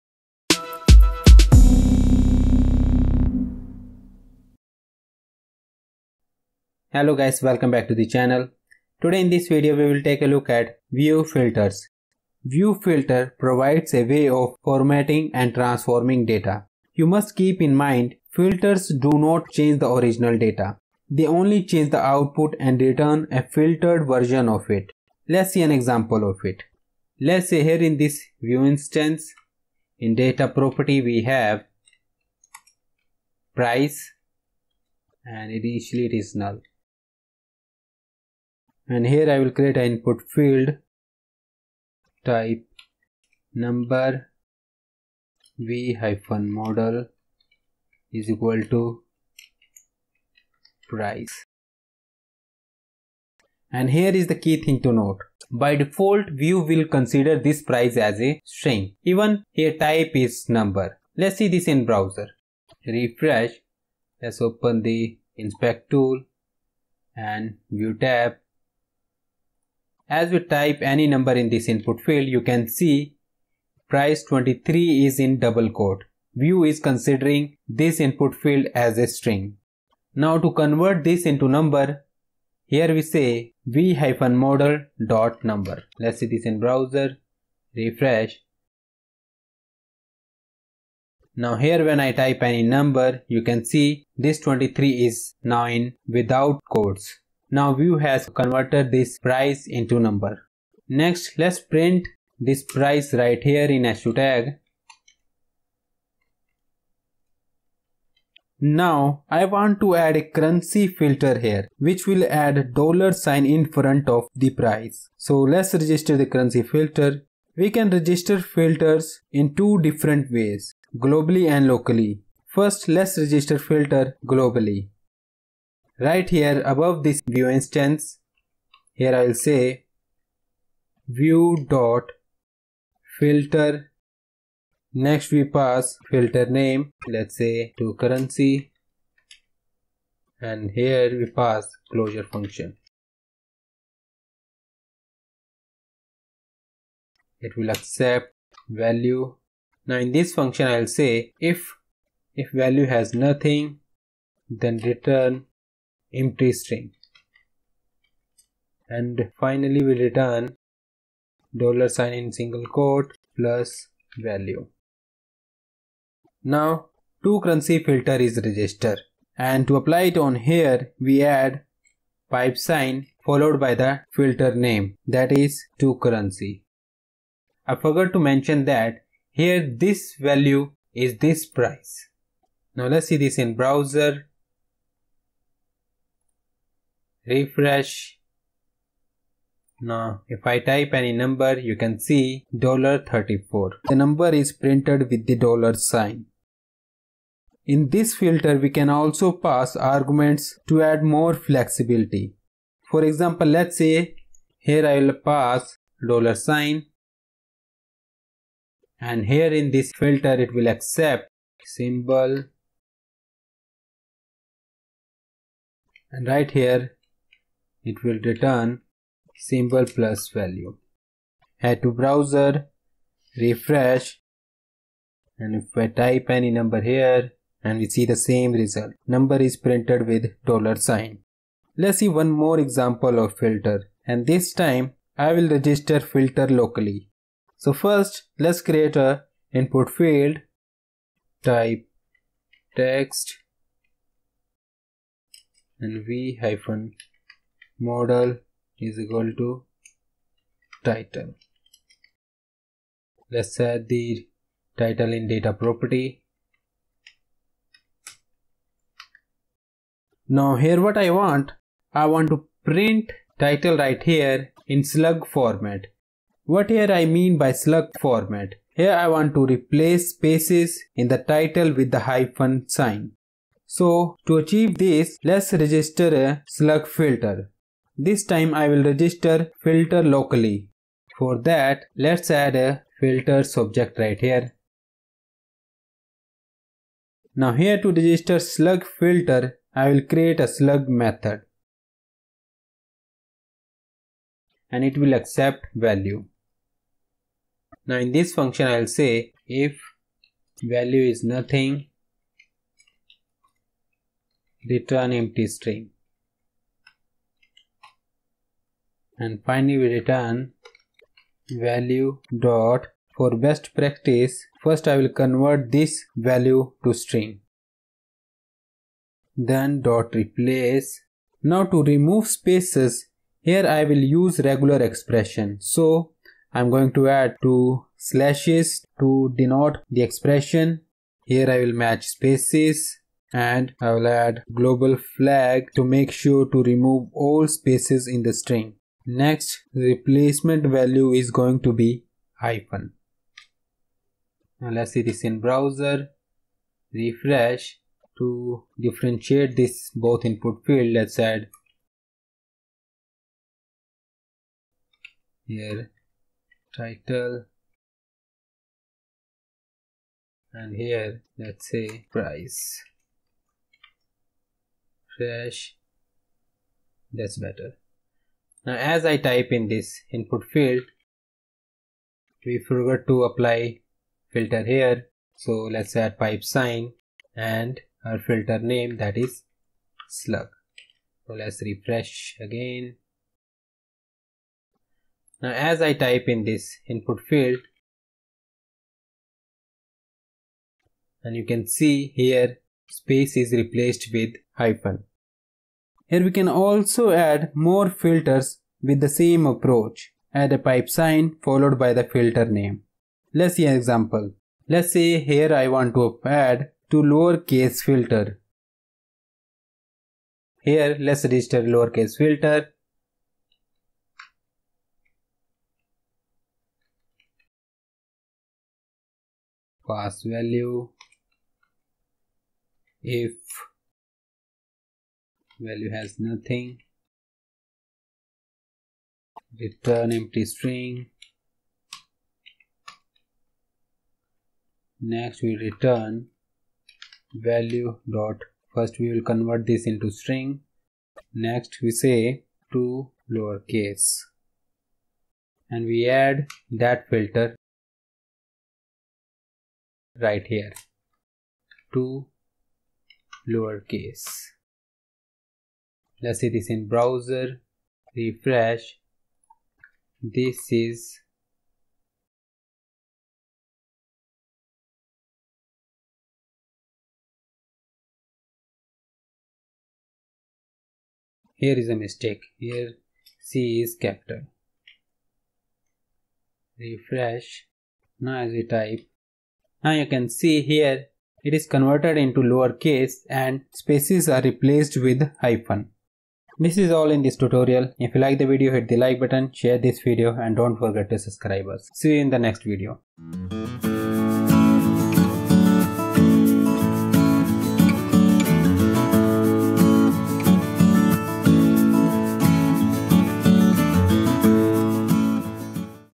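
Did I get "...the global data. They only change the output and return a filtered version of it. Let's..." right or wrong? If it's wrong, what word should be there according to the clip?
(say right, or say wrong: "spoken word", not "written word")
wrong: "original", not "global".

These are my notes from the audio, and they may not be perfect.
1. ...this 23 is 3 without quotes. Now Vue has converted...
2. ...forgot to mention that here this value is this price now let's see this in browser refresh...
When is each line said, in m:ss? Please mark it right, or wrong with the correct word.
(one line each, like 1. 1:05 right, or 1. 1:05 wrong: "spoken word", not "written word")
1. 1:34 wrong: "9", not "3"
2. 2:57 right.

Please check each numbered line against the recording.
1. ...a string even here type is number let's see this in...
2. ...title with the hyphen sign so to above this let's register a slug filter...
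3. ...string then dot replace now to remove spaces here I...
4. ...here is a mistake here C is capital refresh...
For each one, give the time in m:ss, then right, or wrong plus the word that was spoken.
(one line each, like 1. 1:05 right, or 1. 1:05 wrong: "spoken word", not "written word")
1. 0:58 right
2. 4:31 wrong: "achieve", not "above"
3. 5:16 right
4. 7:51 right.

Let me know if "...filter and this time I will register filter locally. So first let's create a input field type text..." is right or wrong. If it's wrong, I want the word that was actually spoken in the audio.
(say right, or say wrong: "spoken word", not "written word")
right.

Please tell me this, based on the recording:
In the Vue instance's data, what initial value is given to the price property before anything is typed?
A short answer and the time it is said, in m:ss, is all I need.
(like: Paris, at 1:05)
null, at 0:36.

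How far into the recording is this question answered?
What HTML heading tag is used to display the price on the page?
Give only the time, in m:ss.
1:43.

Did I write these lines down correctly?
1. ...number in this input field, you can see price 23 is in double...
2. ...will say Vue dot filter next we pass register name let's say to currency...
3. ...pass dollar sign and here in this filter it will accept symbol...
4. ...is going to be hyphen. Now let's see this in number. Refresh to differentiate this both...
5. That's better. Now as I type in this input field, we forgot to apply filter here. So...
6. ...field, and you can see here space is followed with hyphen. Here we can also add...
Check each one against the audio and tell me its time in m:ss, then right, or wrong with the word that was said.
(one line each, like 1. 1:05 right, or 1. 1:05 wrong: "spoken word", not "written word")
1. 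1:11 right
2. 2:09 wrong: "filter", not "register"
3. 3:25 right
4. 5:41 wrong: "browser", not "number"
5. 6:07 right
6. 6:27 wrong: "replaced", not "followed".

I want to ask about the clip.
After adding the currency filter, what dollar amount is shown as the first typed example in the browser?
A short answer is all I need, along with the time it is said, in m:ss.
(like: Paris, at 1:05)
$34, at 3:12.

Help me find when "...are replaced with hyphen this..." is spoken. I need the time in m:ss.
8:04.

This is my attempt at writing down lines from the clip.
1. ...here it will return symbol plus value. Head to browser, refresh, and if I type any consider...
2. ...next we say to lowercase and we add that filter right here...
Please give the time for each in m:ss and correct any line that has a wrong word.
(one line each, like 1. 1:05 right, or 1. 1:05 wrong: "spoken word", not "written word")
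1. 3:36 wrong: "number", not "consider"
2. 7:21 right.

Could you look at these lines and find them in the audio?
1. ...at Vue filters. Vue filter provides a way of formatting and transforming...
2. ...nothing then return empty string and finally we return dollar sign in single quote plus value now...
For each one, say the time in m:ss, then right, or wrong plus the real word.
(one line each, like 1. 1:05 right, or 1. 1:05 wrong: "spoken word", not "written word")
1. 0:10 right
2. 2:33 right.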